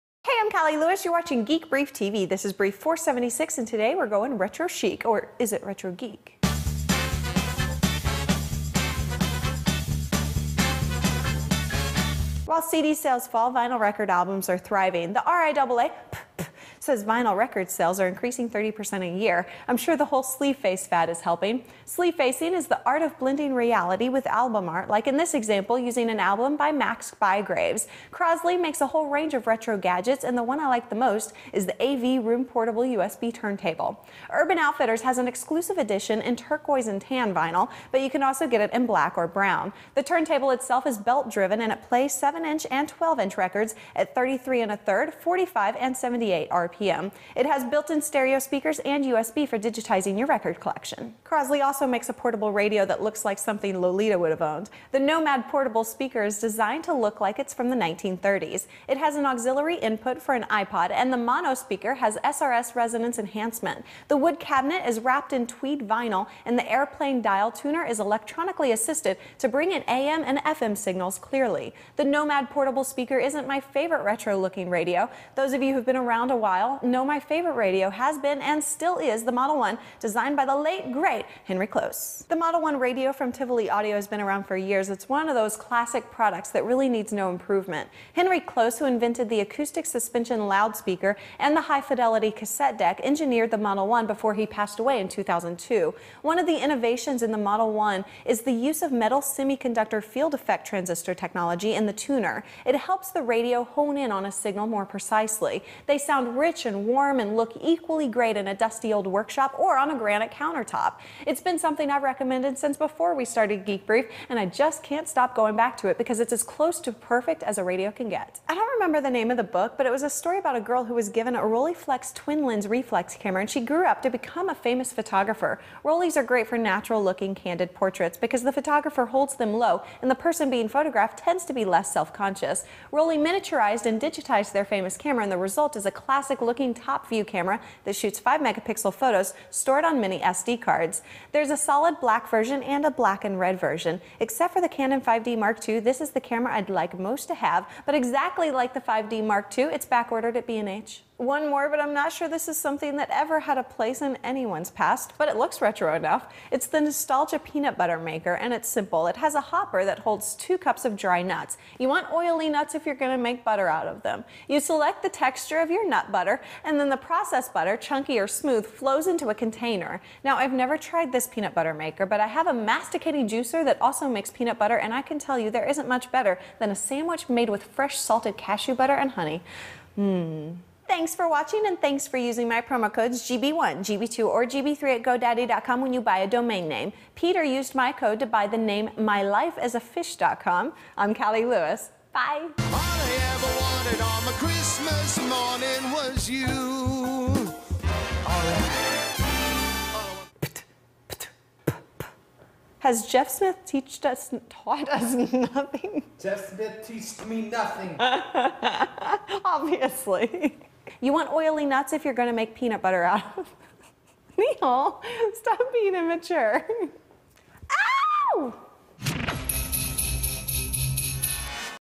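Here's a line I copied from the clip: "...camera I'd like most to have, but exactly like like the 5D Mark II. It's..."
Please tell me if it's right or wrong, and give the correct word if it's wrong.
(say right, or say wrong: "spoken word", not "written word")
right.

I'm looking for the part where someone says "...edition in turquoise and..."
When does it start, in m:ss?
0:35.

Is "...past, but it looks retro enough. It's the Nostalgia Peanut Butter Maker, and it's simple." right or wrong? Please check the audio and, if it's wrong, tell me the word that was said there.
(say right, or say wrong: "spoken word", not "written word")
right.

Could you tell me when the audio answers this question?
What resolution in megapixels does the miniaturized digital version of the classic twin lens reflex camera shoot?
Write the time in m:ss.
2:18.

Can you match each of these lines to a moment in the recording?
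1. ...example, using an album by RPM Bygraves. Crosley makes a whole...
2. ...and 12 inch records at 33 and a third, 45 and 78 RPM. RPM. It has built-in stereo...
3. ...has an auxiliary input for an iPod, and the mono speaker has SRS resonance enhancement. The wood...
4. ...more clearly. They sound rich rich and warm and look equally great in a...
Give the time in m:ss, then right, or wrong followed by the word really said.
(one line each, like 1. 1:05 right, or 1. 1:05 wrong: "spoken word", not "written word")
1. 0:25 wrong: "Max", not "RPM"
2. 0:42 right
3. 0:58 right
4. 1:44 wrong: "precisely", not "clearly".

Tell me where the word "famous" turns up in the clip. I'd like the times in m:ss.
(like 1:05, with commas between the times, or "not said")
2:04, 2:14.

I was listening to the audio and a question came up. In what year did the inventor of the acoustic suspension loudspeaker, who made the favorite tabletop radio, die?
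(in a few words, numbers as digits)
2002.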